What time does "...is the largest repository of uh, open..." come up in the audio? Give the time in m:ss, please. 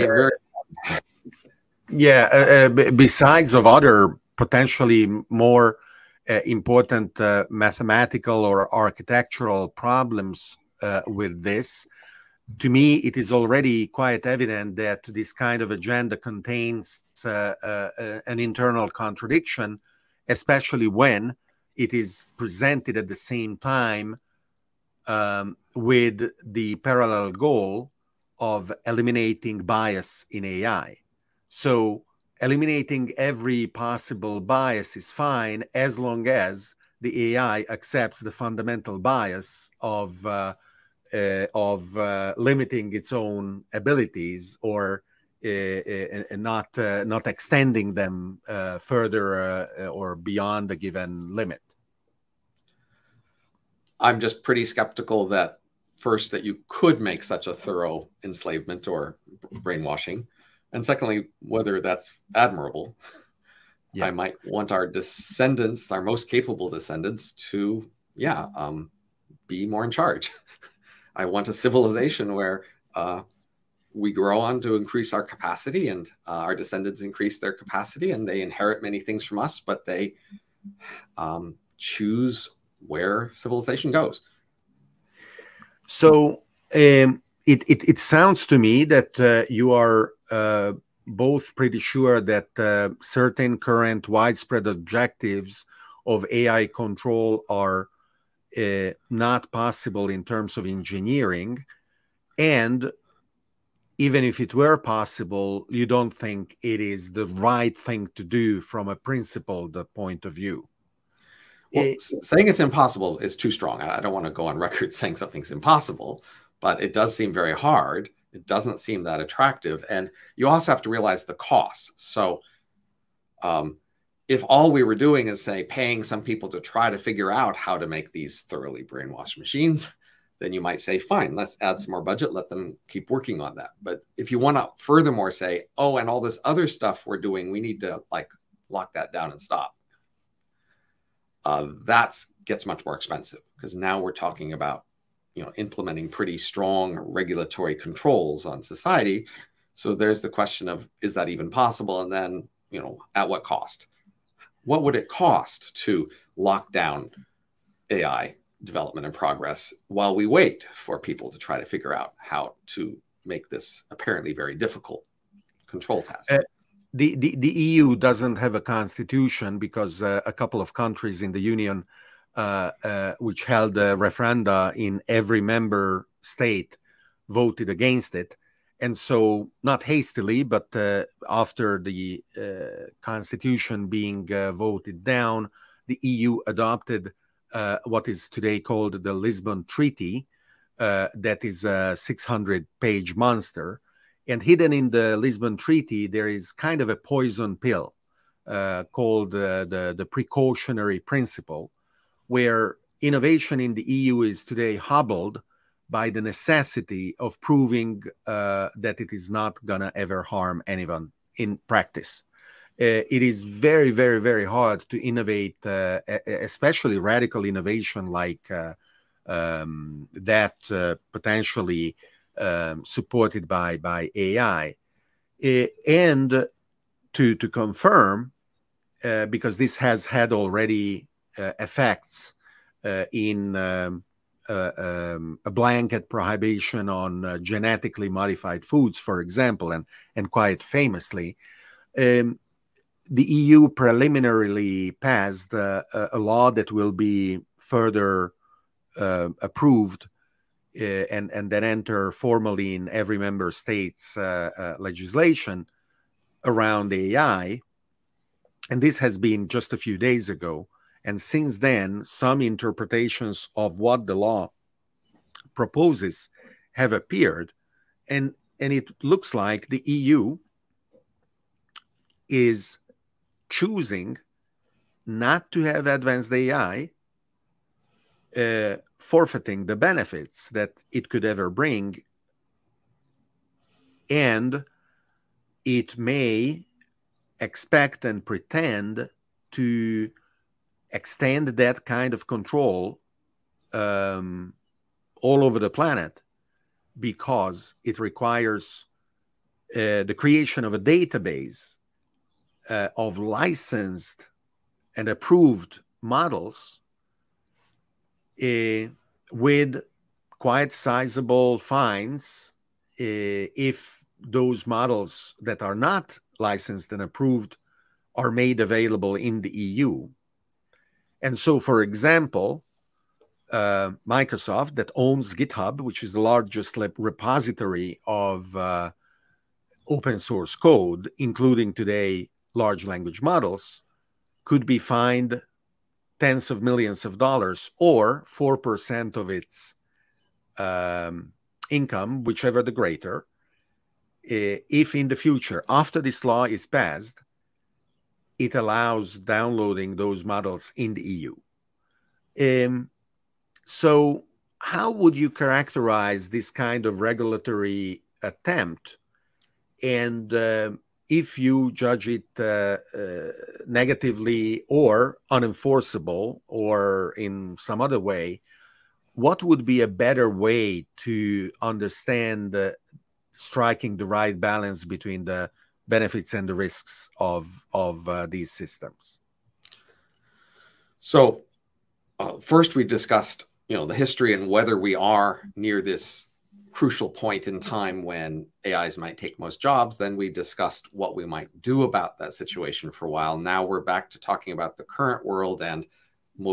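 5:26.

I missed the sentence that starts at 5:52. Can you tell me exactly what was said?
Um, so, how would you characterize this kind of regulatory attempt?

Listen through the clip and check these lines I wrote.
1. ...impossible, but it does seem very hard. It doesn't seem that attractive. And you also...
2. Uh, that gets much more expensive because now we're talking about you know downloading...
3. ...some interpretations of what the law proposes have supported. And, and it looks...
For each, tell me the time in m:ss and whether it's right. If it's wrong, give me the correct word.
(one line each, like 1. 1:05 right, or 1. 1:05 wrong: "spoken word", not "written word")
1. 1:55 right
2. 2:21 wrong: "implementing", not "downloading"
3. 4:22 wrong: "appeared", not "supported".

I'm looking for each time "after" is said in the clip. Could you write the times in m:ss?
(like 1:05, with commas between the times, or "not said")
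3:01, 5:45.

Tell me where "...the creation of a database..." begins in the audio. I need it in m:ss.
5:00.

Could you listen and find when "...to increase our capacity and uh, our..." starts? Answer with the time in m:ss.
1:14.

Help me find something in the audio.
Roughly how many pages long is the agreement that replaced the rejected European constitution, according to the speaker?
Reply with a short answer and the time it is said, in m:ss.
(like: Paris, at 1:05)
600, at 3:11.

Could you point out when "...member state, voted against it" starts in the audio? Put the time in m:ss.
2:55.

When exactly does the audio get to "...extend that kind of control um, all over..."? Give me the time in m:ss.
4:50.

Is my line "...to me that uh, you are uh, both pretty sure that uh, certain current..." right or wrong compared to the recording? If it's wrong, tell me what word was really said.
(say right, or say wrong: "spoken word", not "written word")
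right.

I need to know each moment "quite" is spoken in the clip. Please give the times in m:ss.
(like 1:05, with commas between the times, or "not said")
0:13, 4:00, 5:10.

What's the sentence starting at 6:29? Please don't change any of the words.
Then we discussed what we might do about that situation for a while.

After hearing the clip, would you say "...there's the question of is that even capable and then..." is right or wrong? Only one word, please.
wrong.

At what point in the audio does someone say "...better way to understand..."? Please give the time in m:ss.
6:09.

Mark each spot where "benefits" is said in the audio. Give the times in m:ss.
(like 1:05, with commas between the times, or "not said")
4:39, 6:15.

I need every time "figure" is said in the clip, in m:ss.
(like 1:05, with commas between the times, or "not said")
2:06, 2:41.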